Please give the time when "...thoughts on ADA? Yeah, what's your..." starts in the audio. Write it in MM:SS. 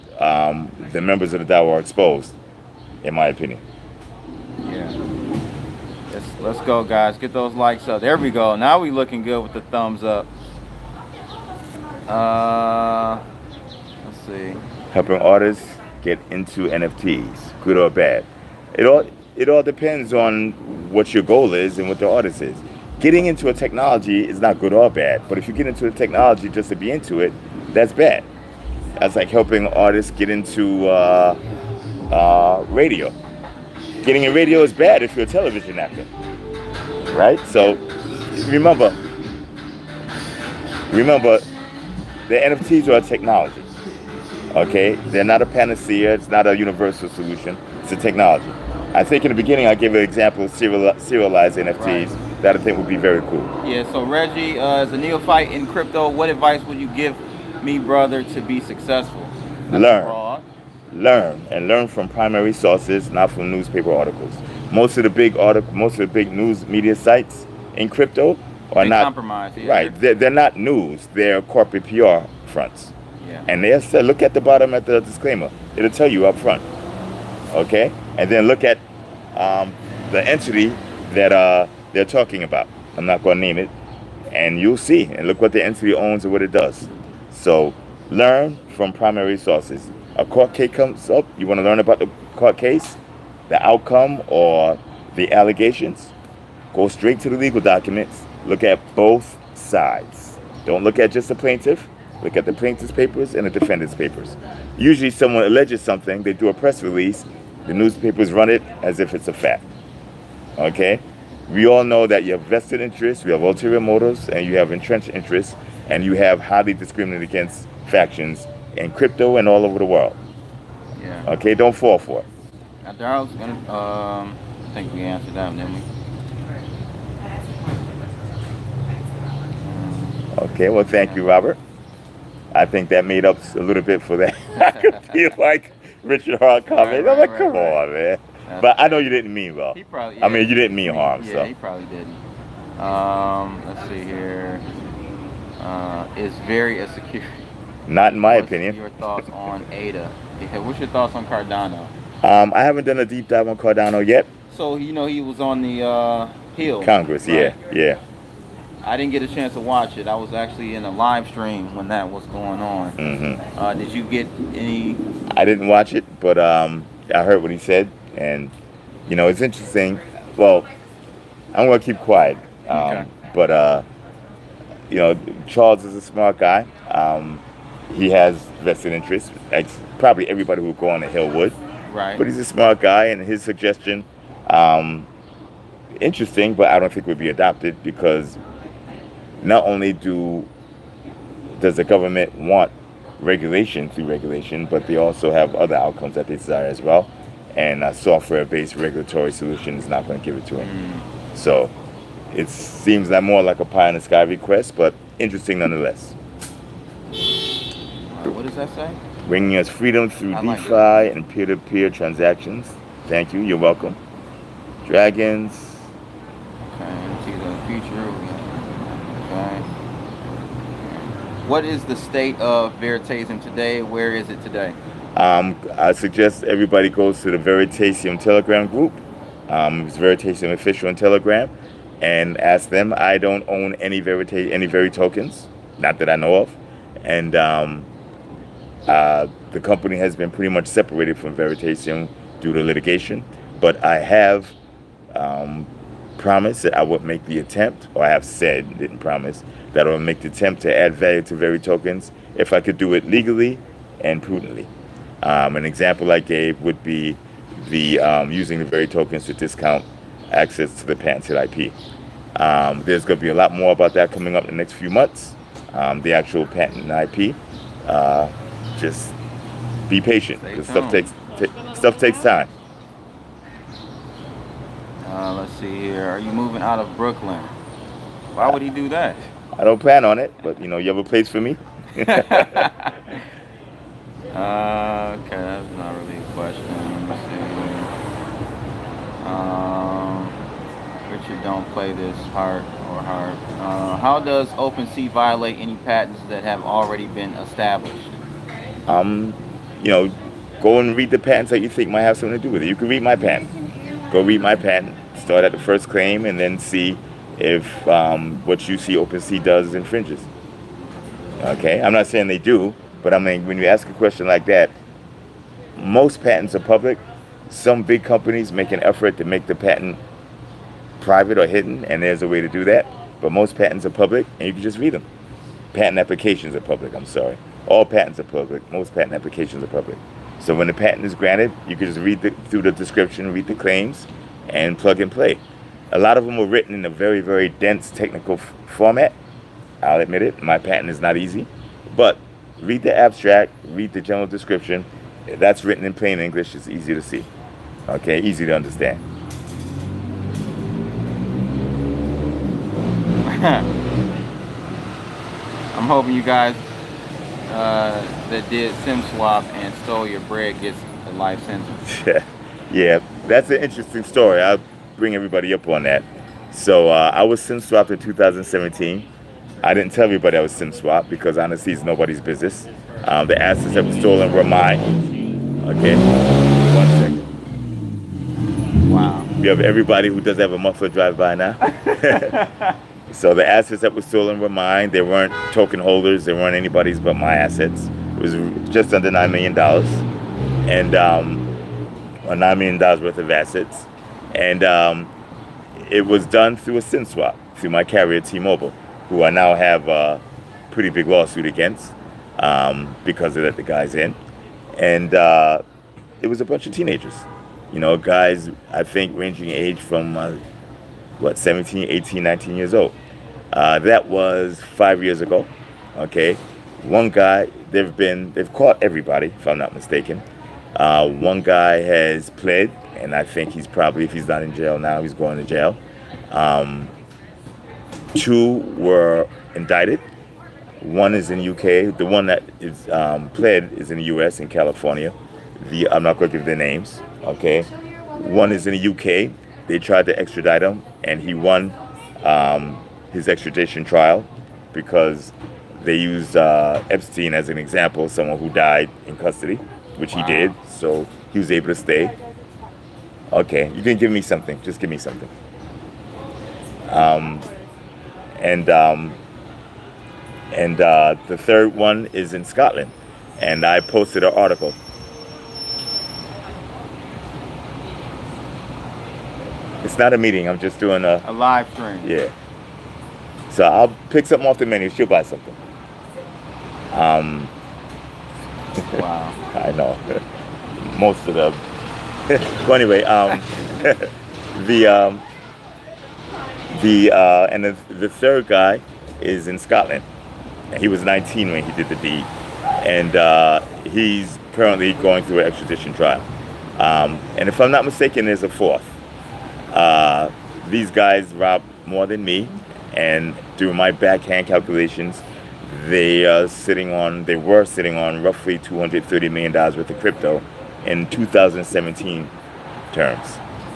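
02:28.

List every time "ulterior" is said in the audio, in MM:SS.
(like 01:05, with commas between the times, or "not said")
01:53.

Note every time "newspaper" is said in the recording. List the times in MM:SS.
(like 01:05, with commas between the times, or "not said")
01:03, 01:47.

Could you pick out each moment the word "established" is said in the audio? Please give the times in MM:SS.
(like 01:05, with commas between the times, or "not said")
04:57.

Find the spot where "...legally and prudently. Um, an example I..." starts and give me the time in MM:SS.
04:13.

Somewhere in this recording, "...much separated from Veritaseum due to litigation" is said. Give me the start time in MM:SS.
04:00.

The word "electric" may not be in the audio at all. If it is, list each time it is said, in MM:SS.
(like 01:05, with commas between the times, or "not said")
not said.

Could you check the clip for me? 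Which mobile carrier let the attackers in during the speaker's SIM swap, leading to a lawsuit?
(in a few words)
T-Mobile.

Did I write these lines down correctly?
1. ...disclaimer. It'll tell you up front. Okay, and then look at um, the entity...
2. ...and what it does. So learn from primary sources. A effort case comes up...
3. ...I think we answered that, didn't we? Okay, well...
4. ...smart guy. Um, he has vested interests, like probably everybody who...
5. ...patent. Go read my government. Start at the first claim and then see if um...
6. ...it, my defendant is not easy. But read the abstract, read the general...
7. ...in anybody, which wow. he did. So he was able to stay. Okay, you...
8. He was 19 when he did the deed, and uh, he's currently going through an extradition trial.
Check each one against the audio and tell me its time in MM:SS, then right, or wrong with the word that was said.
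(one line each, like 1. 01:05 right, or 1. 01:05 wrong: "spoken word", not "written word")
1. 01:15 right
2. 01:26 wrong: "court", not "effort"
3. 02:04 right
4. 02:56 right
5. 05:03 wrong: "patent", not "government"
6. 05:40 wrong: "patent", not "defendant"
7. 07:29 wrong: "custody", not "anybody"
8. 08:10 right.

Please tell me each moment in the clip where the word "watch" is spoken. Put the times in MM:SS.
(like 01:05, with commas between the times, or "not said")
02:39, 02:45.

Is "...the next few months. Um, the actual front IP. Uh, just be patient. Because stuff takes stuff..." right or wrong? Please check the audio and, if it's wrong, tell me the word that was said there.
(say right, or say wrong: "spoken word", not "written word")
wrong: "patent", not "front".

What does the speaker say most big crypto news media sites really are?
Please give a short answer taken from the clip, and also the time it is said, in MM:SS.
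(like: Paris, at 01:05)
Corporate PR fronts, at 01:11.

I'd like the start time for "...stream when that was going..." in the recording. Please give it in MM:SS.
02:41.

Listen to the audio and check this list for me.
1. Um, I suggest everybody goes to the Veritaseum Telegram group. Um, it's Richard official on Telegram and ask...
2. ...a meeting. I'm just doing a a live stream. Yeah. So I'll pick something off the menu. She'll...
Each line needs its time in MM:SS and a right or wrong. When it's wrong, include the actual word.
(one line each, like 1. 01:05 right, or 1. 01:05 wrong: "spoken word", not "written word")
1. 03:45 wrong: "Veritaseum", not "Richard"
2. 07:50 right.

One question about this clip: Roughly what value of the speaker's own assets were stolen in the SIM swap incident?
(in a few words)
Just under $9 million.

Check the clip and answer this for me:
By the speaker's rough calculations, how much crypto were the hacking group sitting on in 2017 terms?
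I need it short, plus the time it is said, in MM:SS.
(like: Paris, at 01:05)
$230 million, at 08:28.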